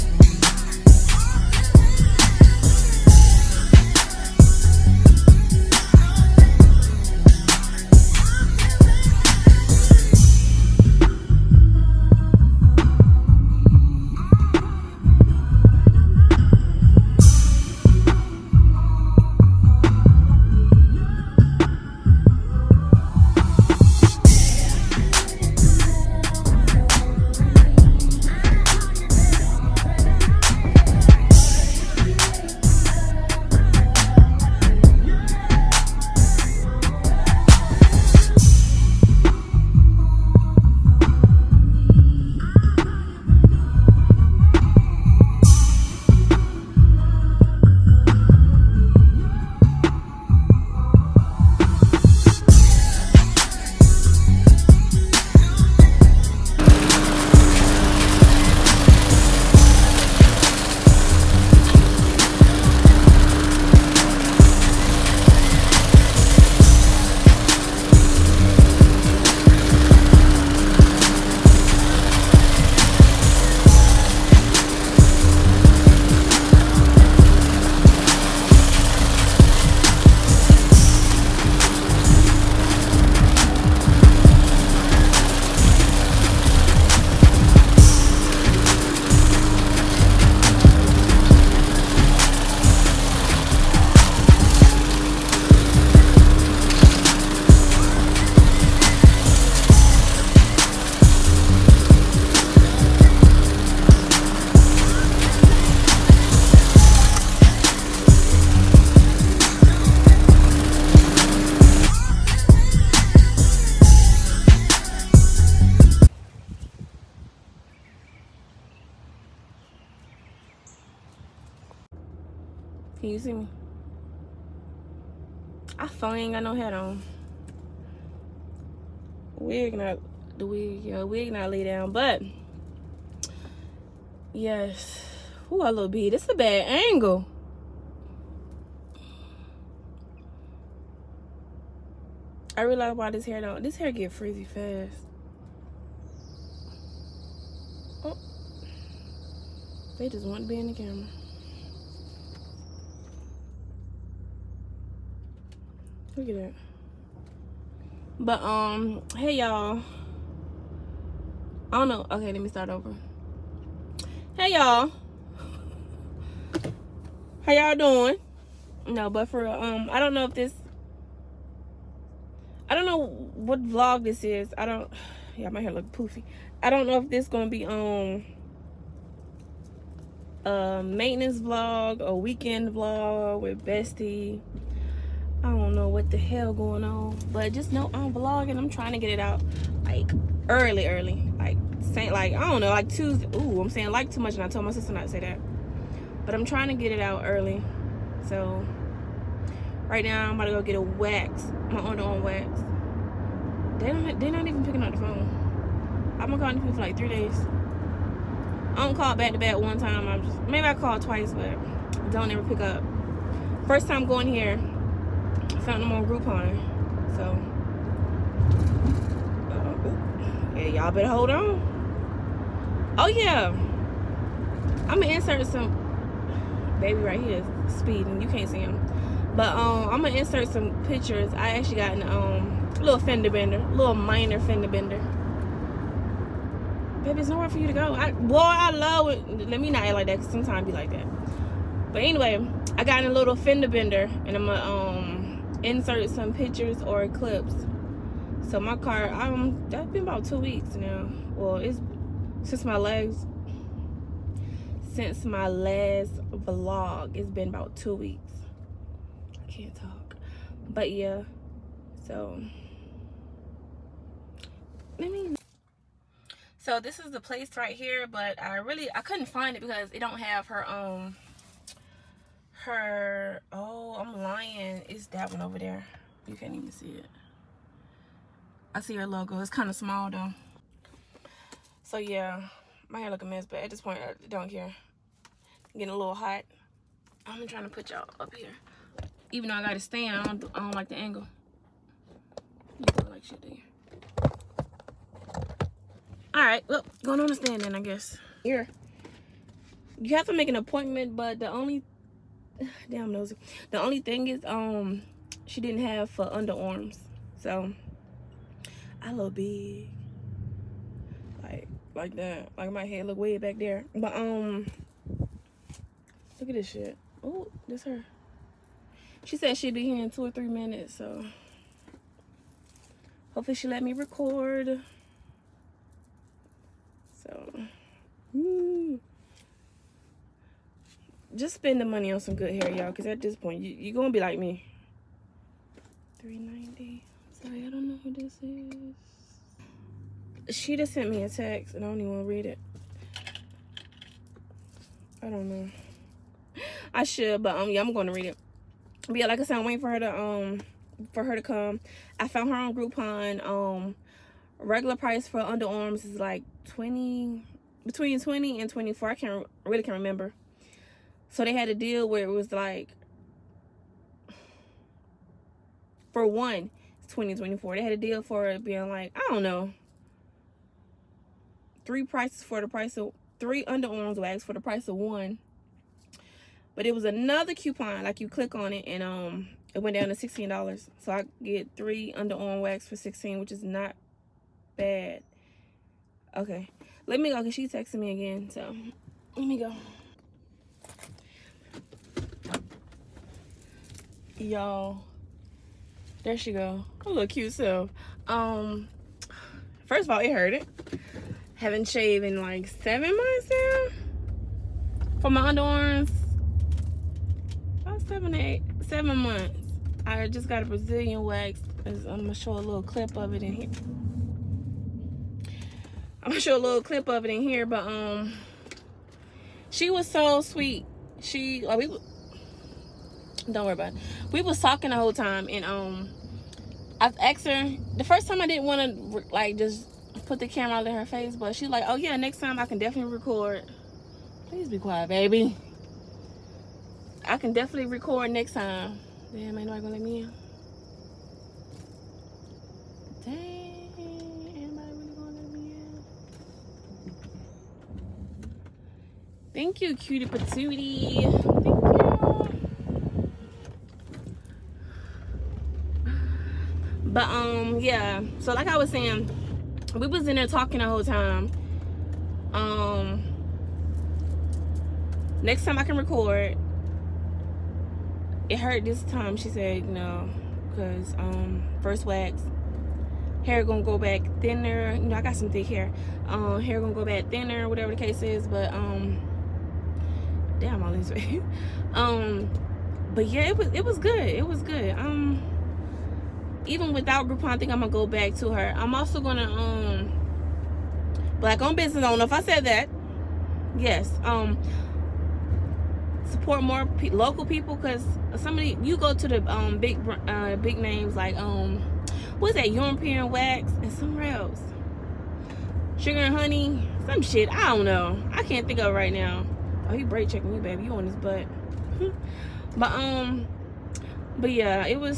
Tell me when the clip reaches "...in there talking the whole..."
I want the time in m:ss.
7:40.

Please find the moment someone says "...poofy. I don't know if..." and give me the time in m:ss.
2:55.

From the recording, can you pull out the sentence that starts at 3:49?
But um, I'm going to insert some pictures.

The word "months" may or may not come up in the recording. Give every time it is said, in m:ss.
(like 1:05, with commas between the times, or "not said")
6:43, 6:49.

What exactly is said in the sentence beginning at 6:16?
But it was another coupon, like you click on it and um it went down to $16.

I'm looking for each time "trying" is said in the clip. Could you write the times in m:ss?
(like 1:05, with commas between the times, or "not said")
3:08, 3:16, 4:47.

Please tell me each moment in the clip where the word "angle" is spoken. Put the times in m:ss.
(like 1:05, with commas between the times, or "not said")
2:16, 4:50.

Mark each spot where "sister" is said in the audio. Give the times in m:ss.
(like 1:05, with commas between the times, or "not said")
3:14.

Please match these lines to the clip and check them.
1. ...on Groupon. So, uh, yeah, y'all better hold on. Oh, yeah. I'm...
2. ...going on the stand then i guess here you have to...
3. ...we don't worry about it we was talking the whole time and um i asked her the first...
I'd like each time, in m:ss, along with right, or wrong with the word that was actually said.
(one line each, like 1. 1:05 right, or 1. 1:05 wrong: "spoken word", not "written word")
1. 3:35 right
2. 4:57 right
3. 7:01 right.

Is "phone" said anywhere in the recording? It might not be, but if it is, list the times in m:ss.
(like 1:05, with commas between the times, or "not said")
2:05, 3:25.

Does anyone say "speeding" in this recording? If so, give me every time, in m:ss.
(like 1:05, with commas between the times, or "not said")
3:47.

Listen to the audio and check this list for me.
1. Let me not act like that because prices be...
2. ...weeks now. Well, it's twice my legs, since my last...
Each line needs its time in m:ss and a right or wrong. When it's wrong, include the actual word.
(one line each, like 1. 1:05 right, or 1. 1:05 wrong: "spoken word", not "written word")
1. 3:59 wrong: "sometimes", not "prices"
2. 4:10 wrong: "since", not "twice".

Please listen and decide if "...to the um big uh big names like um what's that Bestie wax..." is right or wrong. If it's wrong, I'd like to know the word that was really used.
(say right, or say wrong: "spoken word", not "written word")
wrong: "European", not "Bestie".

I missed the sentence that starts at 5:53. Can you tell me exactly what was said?
Um, regular price for underarms is like 20 between 20 and 24.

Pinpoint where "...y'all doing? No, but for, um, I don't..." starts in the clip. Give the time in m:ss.
2:47.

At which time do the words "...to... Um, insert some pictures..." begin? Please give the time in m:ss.
4:04.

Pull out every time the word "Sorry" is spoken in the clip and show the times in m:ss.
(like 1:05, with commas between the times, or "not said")
5:37.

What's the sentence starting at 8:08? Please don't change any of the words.
I'm also gonna um black owned business.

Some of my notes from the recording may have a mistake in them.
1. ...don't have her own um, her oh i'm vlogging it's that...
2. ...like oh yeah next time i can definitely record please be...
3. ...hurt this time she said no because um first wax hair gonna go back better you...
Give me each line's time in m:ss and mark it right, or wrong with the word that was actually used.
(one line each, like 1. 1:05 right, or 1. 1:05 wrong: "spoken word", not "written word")
1. 4:29 wrong: "lying", not "vlogging"
2. 7:11 right
3. 7:48 wrong: "thinner", not "better".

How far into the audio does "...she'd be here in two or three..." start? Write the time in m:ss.
5:19.